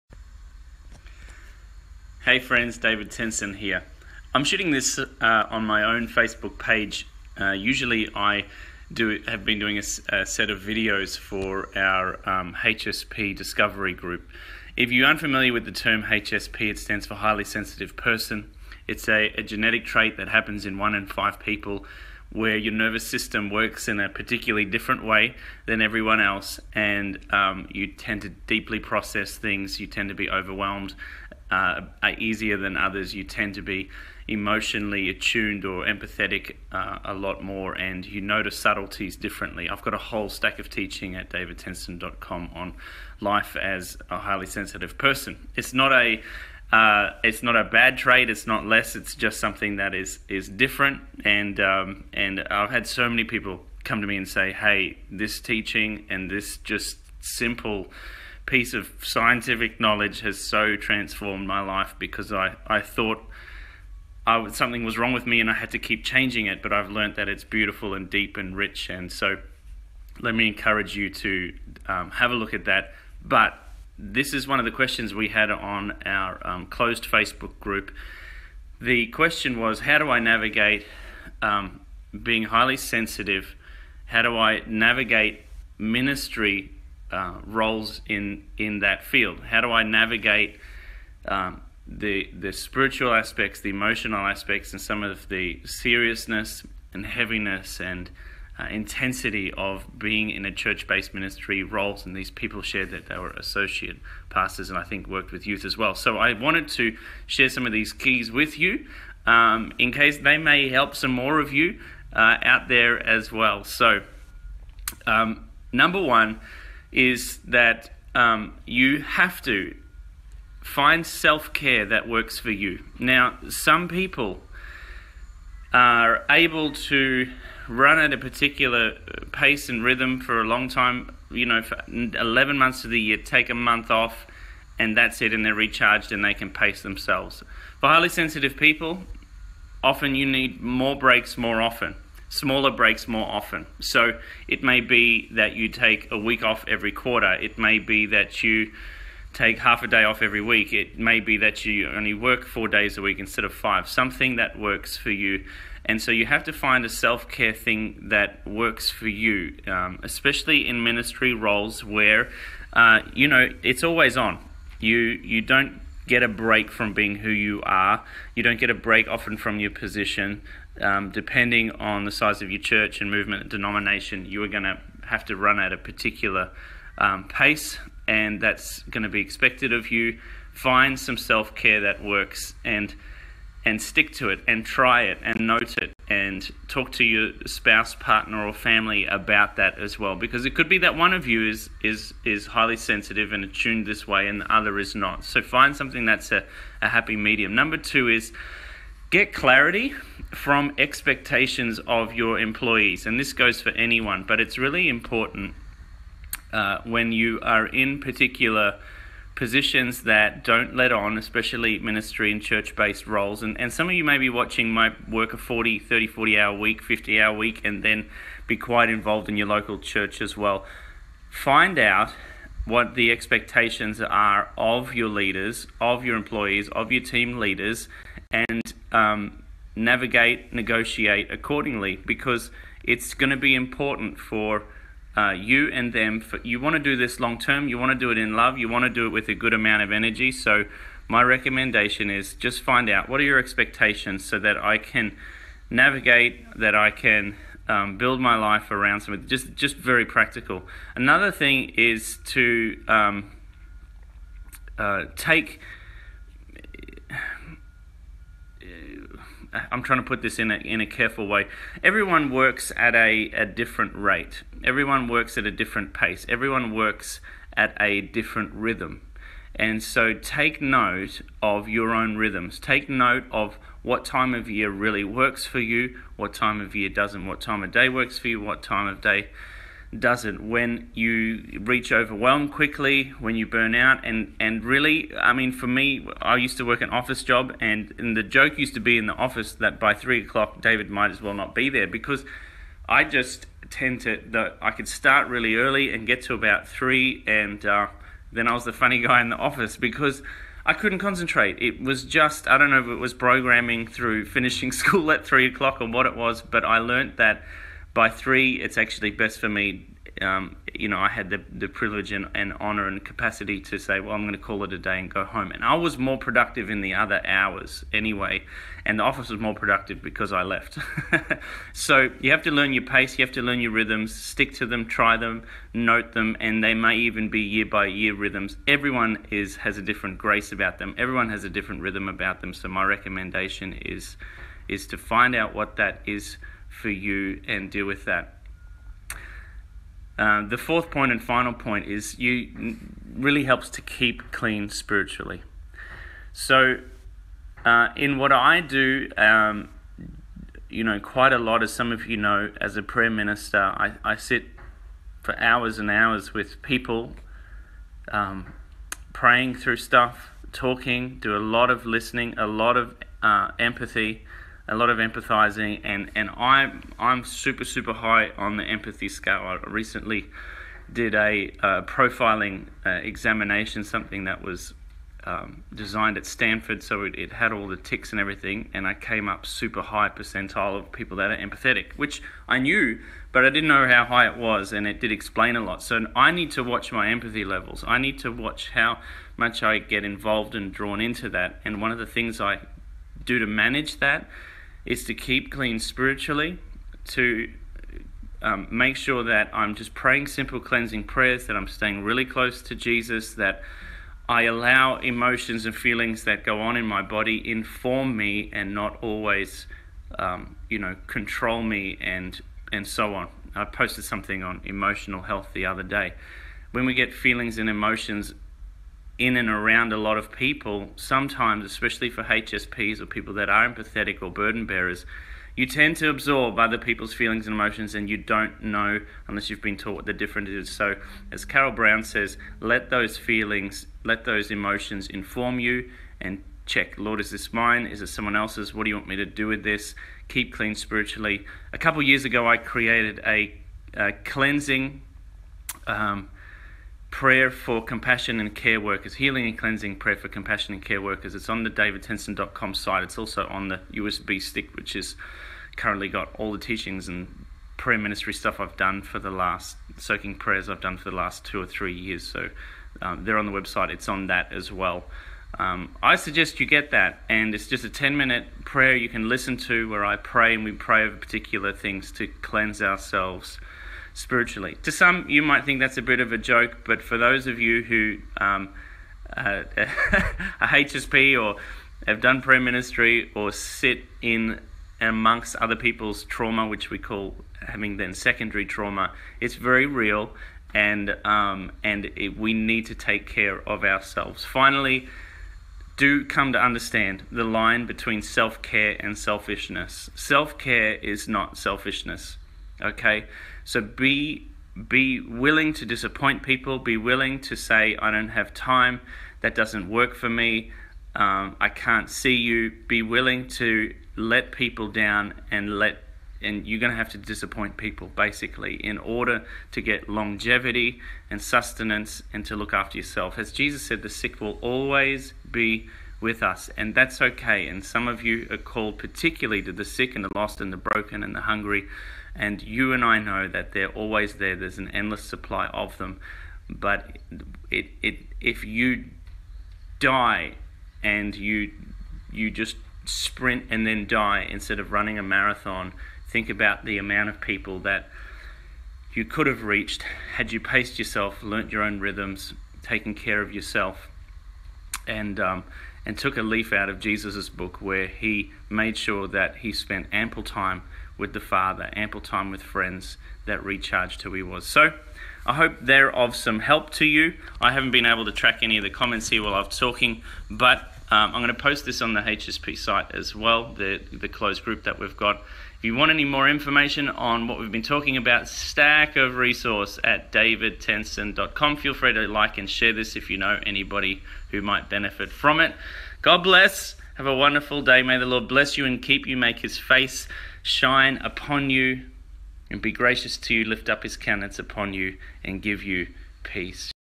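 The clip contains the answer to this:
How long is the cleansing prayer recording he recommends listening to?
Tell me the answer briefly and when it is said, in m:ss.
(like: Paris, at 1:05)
10 minutes, at 7:47.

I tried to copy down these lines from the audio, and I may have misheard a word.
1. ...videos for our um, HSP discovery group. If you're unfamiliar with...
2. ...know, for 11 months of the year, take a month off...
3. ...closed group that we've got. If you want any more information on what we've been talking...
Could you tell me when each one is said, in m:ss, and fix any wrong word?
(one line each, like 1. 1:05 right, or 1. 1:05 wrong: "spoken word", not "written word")
1. 0:10 right
2. 2:11 right
3. 9:34 right.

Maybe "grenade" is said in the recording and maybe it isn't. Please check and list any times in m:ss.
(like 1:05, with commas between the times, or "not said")
not said.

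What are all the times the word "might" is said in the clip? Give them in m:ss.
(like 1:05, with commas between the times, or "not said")
4:50, 7:55, 9:44.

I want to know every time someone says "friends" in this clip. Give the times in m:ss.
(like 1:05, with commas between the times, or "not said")
0:02, 9:22.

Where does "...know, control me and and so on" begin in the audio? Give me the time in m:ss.
6:50.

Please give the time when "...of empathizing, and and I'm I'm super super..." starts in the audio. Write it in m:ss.
6:04.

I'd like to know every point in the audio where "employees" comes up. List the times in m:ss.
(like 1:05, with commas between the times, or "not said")
3:22, 3:46.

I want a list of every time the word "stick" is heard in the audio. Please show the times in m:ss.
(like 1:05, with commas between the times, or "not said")
3:03, 5:24, 7:34.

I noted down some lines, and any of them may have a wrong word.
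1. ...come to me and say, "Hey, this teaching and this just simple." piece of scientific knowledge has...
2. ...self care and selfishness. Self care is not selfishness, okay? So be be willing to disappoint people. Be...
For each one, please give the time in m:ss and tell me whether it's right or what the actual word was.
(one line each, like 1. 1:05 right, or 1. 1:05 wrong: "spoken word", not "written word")
1. 0:53 right
2. 8:18 right.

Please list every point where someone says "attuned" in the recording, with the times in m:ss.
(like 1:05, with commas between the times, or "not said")
0:35, 3:13.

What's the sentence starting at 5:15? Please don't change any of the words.
And I was more productive in the other hours anyway, and the office was more productive because I left.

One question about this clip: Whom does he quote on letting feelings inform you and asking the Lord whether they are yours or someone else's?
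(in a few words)
Carol Brown.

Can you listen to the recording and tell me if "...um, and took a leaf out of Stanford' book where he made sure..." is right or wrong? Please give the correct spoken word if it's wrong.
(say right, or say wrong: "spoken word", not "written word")
wrong: "Jesus", not "Stanford".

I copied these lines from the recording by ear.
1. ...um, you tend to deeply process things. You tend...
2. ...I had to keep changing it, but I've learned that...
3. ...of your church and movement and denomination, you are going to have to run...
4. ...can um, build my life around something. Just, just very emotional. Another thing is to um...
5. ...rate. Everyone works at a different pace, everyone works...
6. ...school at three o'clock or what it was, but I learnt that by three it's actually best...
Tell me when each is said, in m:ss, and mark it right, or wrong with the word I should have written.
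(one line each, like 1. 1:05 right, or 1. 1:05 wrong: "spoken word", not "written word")
1. 0:27 right
2. 1:05 right
3. 2:52 right
4. 4:06 wrong: "practical", not "emotional"
5. 4:23 right
6. 5:04 right.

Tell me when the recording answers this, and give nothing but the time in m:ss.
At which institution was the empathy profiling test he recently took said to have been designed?
6:16.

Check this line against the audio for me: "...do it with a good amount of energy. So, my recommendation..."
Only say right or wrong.
right.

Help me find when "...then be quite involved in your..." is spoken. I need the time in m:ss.
3:37.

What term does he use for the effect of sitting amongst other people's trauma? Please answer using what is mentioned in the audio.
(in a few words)
Secondary trauma.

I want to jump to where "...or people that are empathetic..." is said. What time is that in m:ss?
7:02.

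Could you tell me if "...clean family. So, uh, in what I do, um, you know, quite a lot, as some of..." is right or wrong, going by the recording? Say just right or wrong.
wrong.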